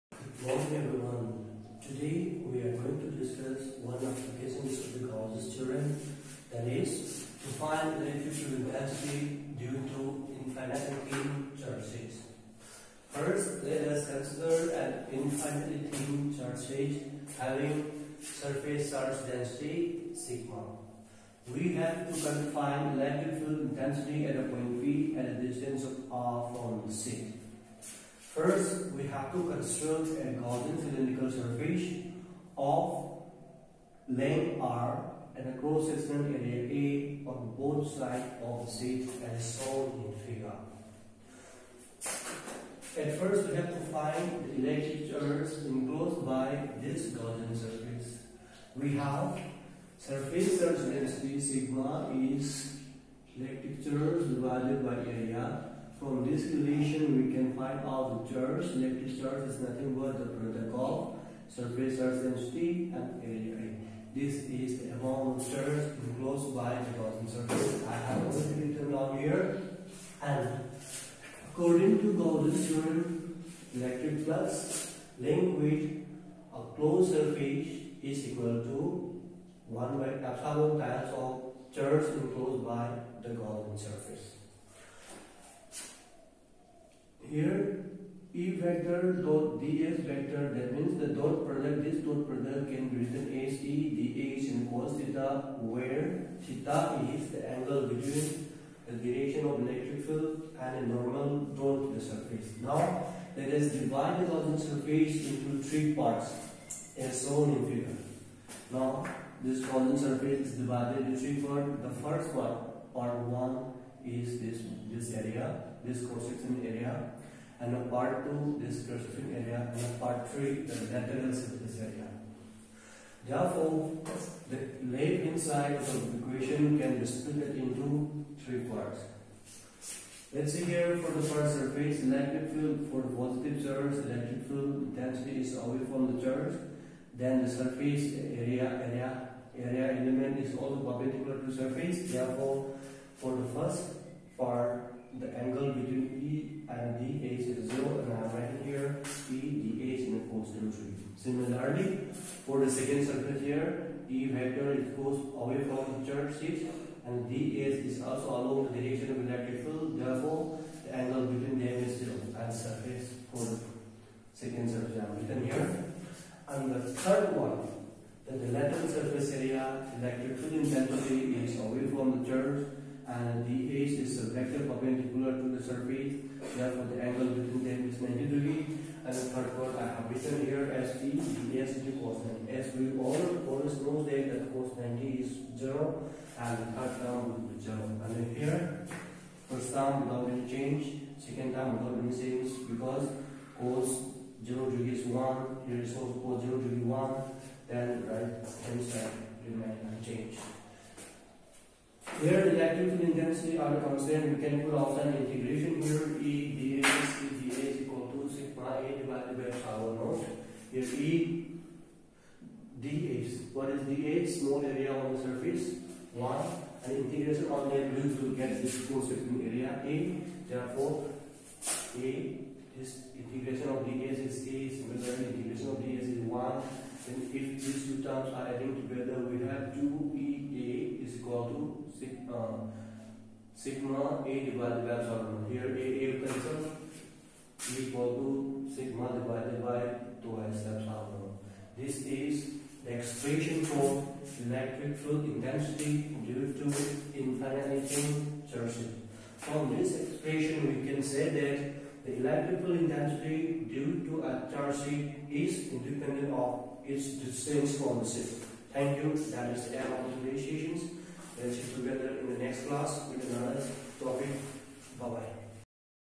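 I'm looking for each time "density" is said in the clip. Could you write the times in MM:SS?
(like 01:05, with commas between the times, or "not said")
00:19, 00:50, 01:02, 02:14.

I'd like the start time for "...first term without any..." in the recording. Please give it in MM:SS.
03:09.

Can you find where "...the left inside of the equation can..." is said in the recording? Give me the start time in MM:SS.
02:04.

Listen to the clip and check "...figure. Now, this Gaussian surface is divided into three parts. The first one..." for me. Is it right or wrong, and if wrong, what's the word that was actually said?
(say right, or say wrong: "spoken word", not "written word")
right.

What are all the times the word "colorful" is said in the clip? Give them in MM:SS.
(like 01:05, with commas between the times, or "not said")
not said.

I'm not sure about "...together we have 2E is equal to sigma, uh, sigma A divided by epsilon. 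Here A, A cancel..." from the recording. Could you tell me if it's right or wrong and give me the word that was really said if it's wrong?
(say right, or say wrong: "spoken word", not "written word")
right.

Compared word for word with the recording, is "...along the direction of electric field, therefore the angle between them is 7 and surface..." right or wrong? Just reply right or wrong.
wrong.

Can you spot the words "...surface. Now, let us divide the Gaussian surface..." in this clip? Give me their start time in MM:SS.
01:42.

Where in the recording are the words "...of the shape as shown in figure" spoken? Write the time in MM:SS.
00:38.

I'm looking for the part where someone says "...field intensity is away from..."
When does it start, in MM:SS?
02:50.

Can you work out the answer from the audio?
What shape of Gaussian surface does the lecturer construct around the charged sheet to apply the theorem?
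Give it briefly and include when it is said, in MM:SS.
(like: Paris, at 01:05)
cylindrical surface, at 00:30.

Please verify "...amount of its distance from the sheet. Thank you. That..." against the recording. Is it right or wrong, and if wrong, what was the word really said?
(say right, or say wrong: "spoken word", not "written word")
wrong: "independent", not "amount".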